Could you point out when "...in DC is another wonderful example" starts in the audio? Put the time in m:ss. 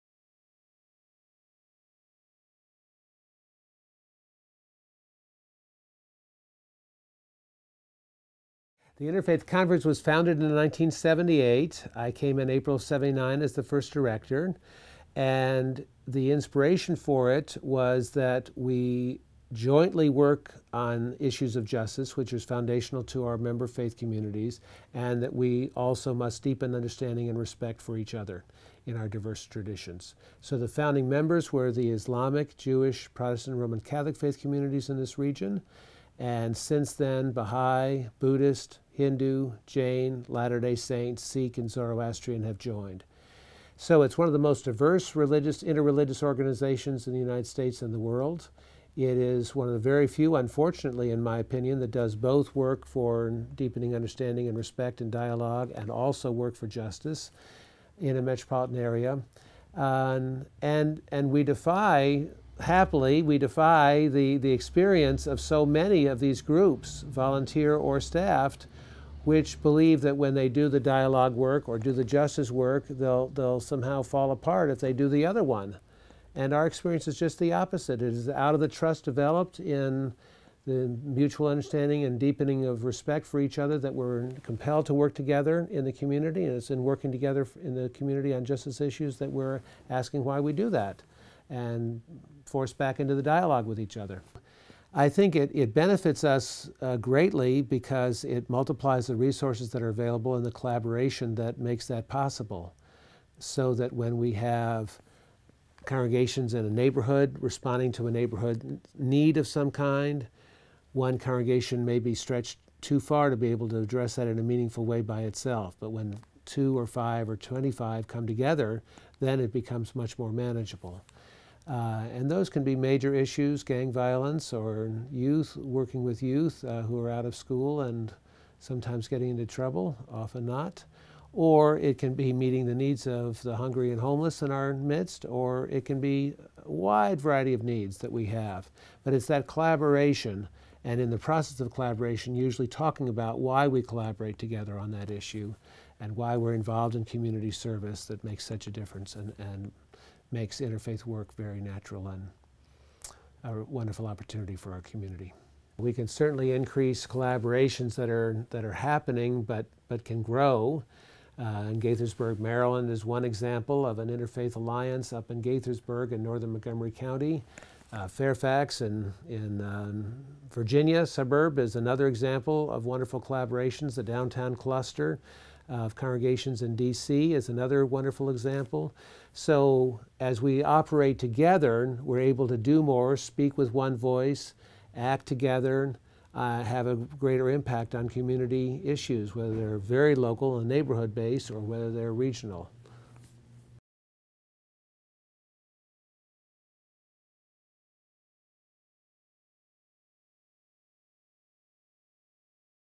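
2:56.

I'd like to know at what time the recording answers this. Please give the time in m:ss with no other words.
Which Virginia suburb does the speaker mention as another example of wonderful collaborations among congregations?
2:48.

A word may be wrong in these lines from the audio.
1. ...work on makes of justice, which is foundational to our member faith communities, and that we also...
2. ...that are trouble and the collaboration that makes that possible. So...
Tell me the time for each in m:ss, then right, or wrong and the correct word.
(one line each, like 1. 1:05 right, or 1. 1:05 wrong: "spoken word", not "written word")
1. 0:20 wrong: "issues", not "makes"
2. 1:39 wrong: "available", not "trouble".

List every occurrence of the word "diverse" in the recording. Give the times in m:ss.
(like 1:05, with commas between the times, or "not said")
0:29, 0:44.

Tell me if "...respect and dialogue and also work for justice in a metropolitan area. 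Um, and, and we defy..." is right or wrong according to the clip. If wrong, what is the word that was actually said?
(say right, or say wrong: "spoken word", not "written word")
right.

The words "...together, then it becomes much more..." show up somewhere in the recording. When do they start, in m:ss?
1:58.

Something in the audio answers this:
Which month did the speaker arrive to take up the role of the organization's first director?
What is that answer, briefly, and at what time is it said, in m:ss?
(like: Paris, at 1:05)
April, at 0:12.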